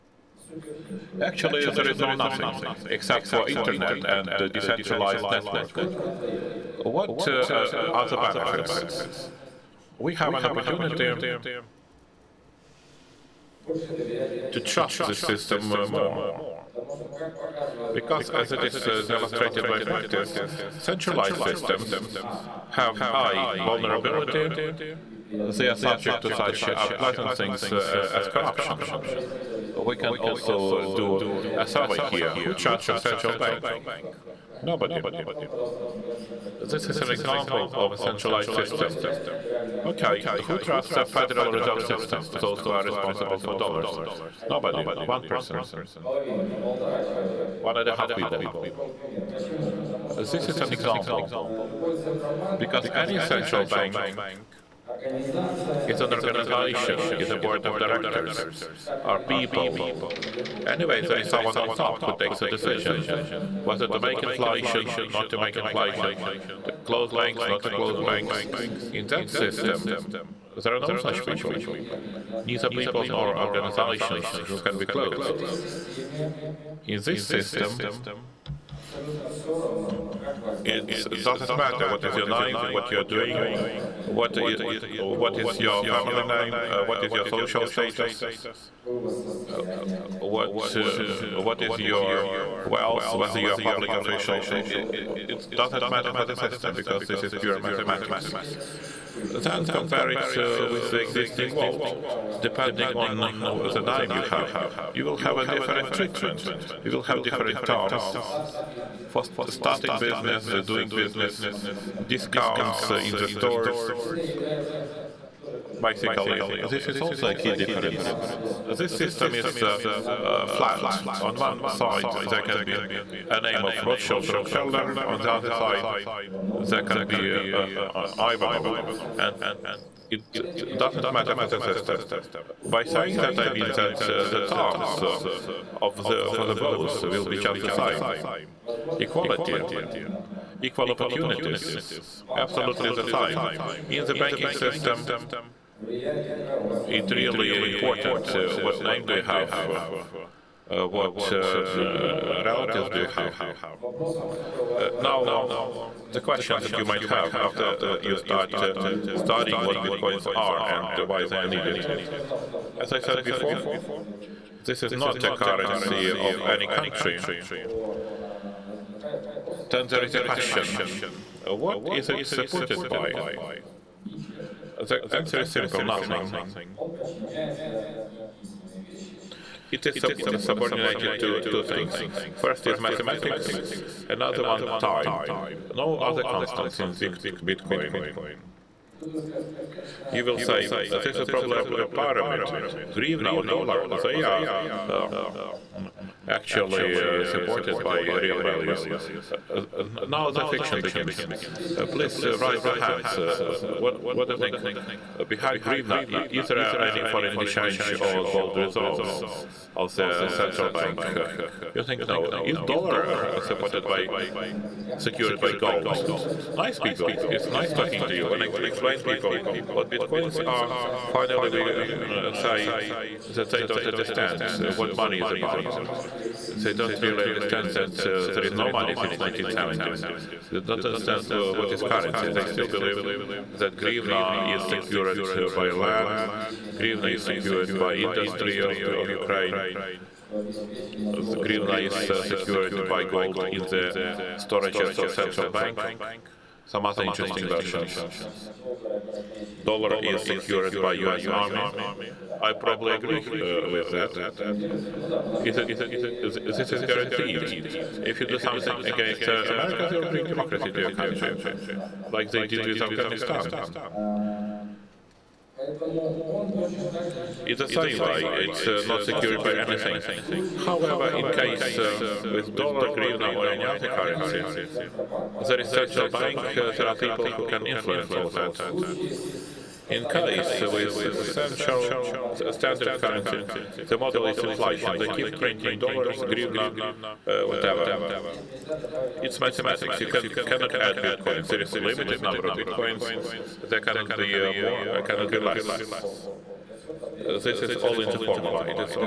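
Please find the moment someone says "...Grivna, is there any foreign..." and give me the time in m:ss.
3:25.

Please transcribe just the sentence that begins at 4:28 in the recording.
It's uh, not secured by anything.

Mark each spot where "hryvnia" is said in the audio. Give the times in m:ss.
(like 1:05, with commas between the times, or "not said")
4:32, 4:46.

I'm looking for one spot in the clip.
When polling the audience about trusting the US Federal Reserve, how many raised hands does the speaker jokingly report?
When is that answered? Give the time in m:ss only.
0:47.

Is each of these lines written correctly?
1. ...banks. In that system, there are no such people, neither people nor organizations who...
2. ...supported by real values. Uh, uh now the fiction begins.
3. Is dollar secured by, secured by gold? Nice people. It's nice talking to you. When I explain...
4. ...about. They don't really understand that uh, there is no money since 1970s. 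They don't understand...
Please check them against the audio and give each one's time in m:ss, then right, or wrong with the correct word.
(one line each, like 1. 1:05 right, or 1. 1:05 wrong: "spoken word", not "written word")
1. 1:08 right
2. 3:17 right
3. 3:32 wrong: "supported", not "secured"
4. 3:45 right.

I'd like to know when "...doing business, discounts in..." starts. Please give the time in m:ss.
1:50.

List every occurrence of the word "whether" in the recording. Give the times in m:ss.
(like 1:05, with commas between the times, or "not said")
1:03, 1:33.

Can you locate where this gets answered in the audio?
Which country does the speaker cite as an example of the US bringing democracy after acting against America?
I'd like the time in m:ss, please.
4:22.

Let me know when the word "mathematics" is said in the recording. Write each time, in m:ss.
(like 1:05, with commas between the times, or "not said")
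1:37, 3:02, 4:49.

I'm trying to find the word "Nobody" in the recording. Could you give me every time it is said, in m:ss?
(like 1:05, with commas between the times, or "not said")
0:34, 0:44.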